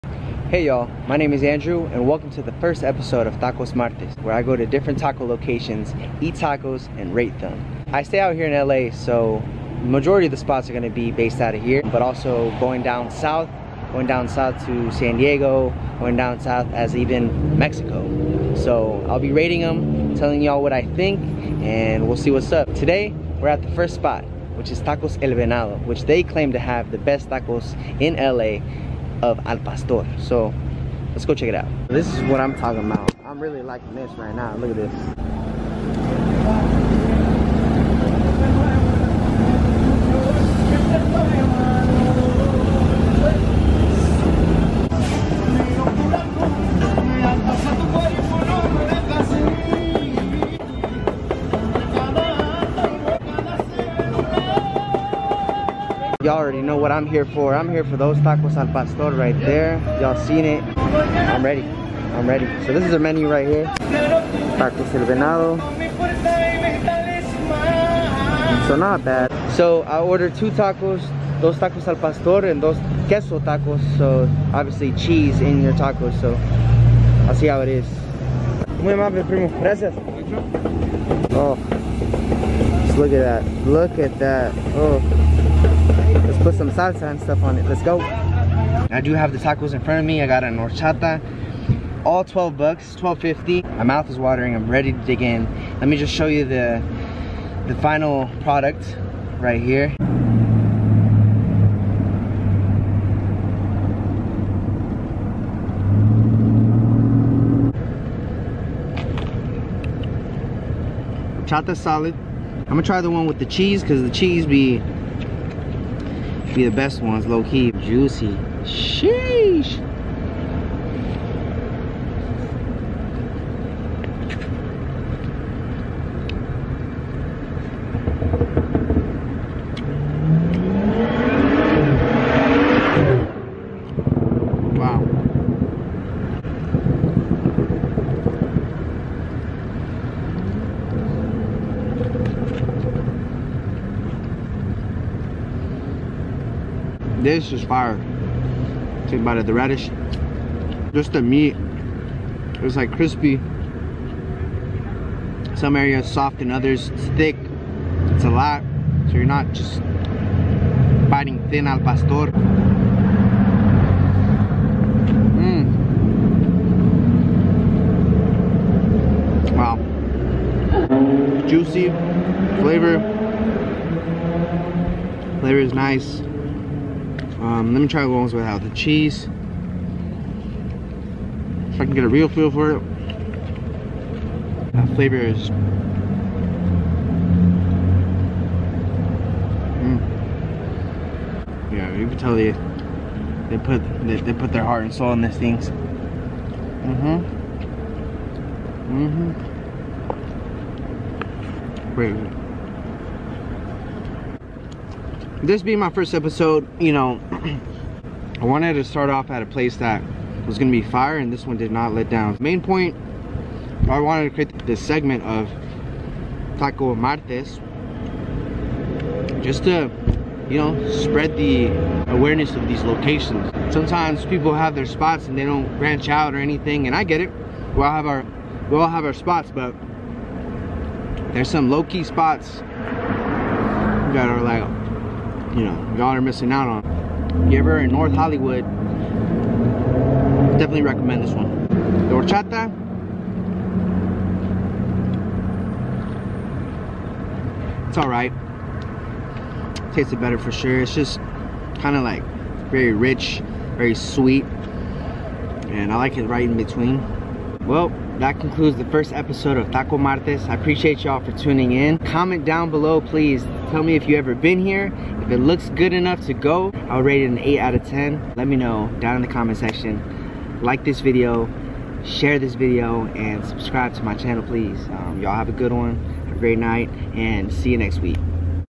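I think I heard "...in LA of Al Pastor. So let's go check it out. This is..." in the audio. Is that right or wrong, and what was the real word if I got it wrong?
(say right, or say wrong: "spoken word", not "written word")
right.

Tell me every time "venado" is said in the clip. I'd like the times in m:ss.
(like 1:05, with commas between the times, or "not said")
0:25, 1:05.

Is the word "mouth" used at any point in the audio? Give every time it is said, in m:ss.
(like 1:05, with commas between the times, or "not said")
1:33.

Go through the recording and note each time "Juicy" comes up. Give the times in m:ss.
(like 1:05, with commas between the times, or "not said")
1:57, 2:51.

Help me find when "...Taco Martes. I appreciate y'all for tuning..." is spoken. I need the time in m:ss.
4:19.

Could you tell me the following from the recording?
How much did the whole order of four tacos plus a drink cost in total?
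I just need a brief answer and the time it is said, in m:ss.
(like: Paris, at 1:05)
$12.50, at 1:32.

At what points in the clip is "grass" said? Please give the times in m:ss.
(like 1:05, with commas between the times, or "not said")
not said.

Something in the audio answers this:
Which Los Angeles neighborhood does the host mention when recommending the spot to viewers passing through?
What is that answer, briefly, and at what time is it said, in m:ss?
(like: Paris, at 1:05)
North Hollywood, at 3:57.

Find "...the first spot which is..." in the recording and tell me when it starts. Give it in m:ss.
0:23.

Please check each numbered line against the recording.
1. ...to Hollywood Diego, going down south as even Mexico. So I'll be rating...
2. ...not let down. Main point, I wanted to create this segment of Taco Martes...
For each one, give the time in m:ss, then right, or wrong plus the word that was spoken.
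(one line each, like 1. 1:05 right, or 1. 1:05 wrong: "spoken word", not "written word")
1. 0:14 wrong: "San", not "Hollywood"
2. 3:31 right.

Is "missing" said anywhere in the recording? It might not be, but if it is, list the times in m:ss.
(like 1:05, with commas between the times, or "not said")
3:56.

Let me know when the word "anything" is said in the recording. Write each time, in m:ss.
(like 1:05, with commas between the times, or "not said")
3:46.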